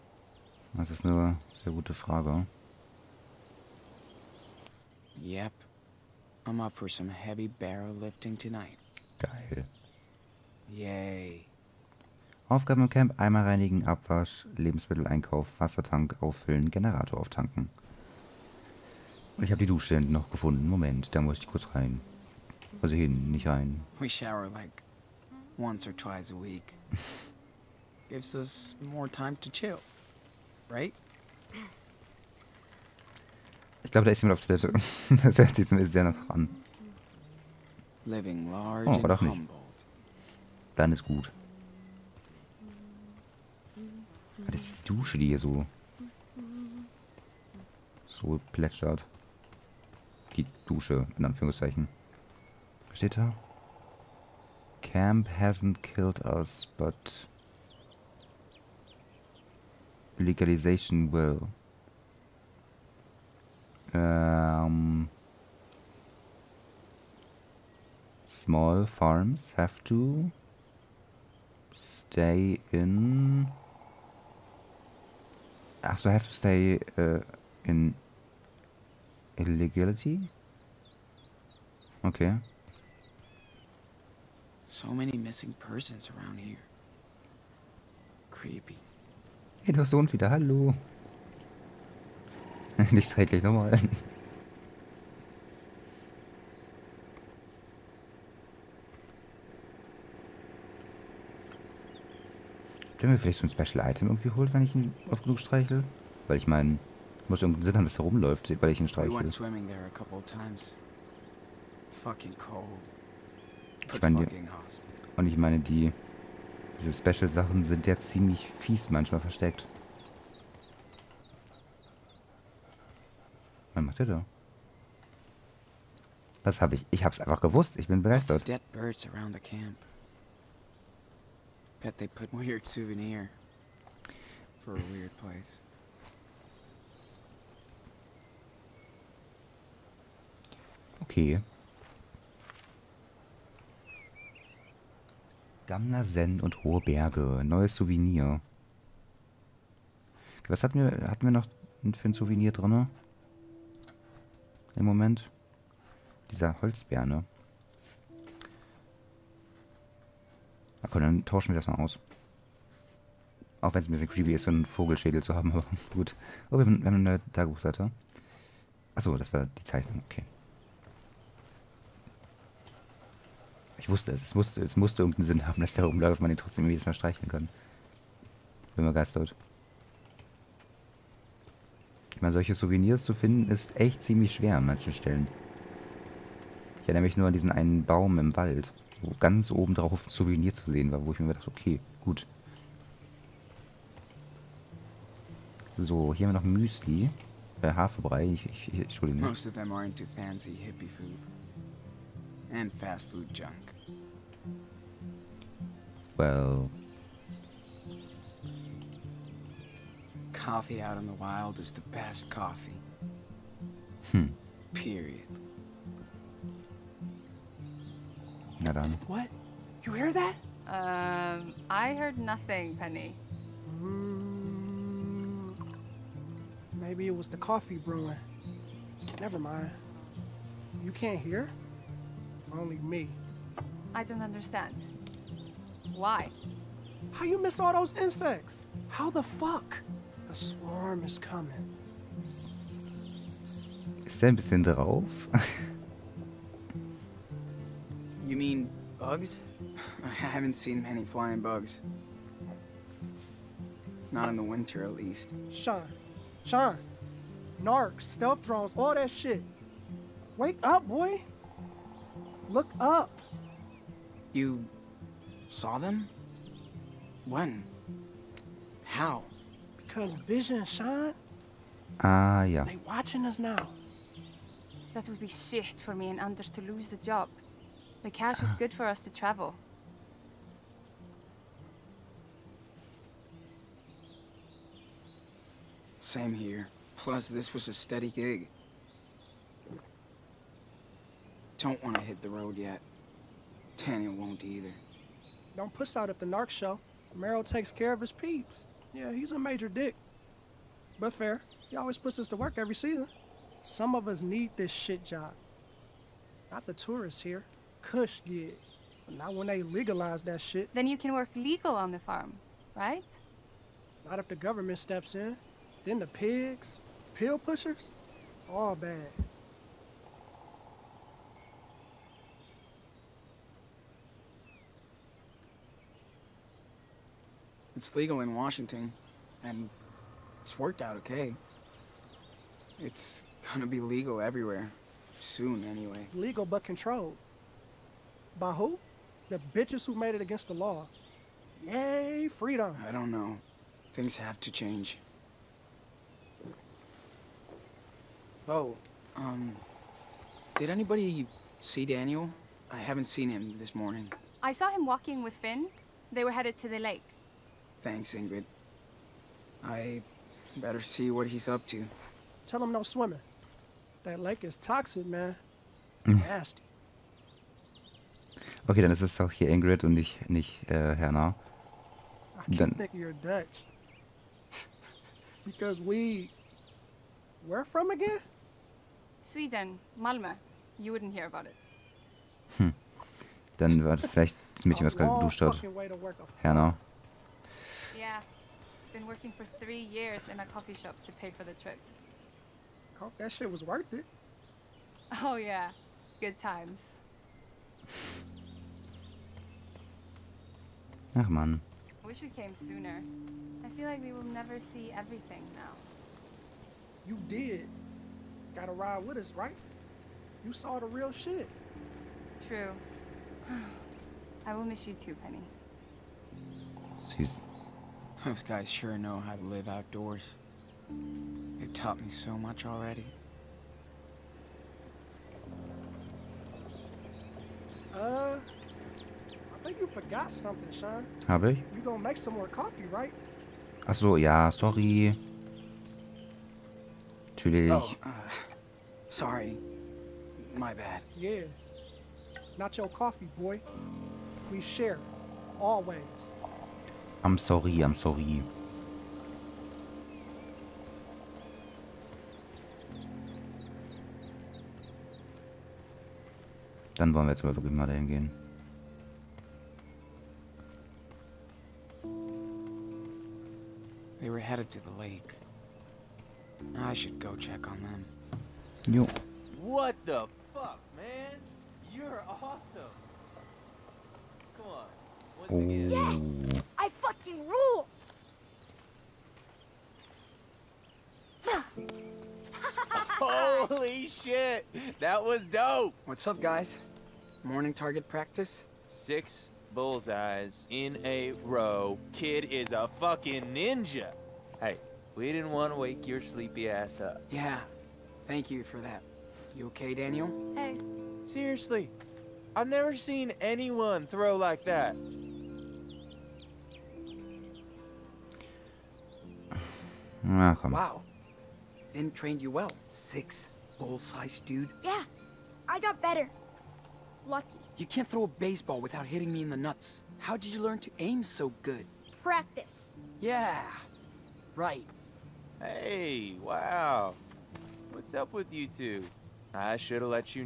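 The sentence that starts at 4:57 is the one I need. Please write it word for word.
Merrill takes care of his peeps.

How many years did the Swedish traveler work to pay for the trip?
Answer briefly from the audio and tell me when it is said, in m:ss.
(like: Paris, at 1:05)
3, at 6:29.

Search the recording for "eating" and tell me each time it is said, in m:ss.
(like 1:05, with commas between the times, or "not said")
not said.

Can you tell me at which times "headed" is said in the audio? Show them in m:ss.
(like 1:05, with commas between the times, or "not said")
5:56, 7:44.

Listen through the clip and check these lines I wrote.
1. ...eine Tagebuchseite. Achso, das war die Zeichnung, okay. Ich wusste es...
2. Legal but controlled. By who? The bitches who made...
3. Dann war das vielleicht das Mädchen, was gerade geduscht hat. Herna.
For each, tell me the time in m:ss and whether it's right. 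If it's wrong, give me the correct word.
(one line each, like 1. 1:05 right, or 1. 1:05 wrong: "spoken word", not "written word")
1. 2:47 right
2. 5:36 right
3. 6:23 right.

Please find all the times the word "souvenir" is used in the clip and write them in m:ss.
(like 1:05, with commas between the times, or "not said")
2:12, 2:27, 2:32, 3:02, 3:10.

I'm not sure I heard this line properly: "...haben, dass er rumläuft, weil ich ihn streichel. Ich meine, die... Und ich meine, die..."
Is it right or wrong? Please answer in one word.
right.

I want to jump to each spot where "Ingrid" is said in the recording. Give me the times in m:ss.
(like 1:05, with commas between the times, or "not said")
5:58, 6:09.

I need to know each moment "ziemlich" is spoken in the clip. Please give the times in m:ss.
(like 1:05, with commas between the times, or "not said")
1:57, 3:04.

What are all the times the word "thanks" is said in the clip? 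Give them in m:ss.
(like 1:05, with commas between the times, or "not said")
5:57, 8:18.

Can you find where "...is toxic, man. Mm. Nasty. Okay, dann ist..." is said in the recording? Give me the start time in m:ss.
6:04.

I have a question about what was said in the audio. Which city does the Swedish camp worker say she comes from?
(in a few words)
Malmö.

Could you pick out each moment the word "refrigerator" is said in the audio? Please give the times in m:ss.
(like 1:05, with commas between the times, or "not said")
not said.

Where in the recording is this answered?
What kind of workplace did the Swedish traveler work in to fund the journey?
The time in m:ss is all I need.
6:30.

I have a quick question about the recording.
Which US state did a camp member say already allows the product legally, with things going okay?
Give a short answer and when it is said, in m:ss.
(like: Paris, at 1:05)
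Washington, at 5:28.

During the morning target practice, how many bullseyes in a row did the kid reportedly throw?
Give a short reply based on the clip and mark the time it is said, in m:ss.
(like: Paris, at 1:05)
6, at 8:08.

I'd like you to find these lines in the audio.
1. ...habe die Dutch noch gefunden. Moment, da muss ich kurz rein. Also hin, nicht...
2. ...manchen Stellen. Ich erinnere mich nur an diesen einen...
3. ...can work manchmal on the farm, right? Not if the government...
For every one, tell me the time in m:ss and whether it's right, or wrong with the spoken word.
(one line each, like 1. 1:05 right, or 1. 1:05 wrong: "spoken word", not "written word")
1. 0:19 wrong: "Dusche", not "Dutch"
2. 3:04 right
3. 5:10 wrong: "legal", not "manchmal".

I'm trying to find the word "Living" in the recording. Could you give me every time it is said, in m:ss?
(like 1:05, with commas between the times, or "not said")
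0:38.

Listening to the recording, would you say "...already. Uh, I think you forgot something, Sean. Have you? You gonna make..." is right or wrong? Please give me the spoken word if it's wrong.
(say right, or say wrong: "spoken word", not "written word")
right.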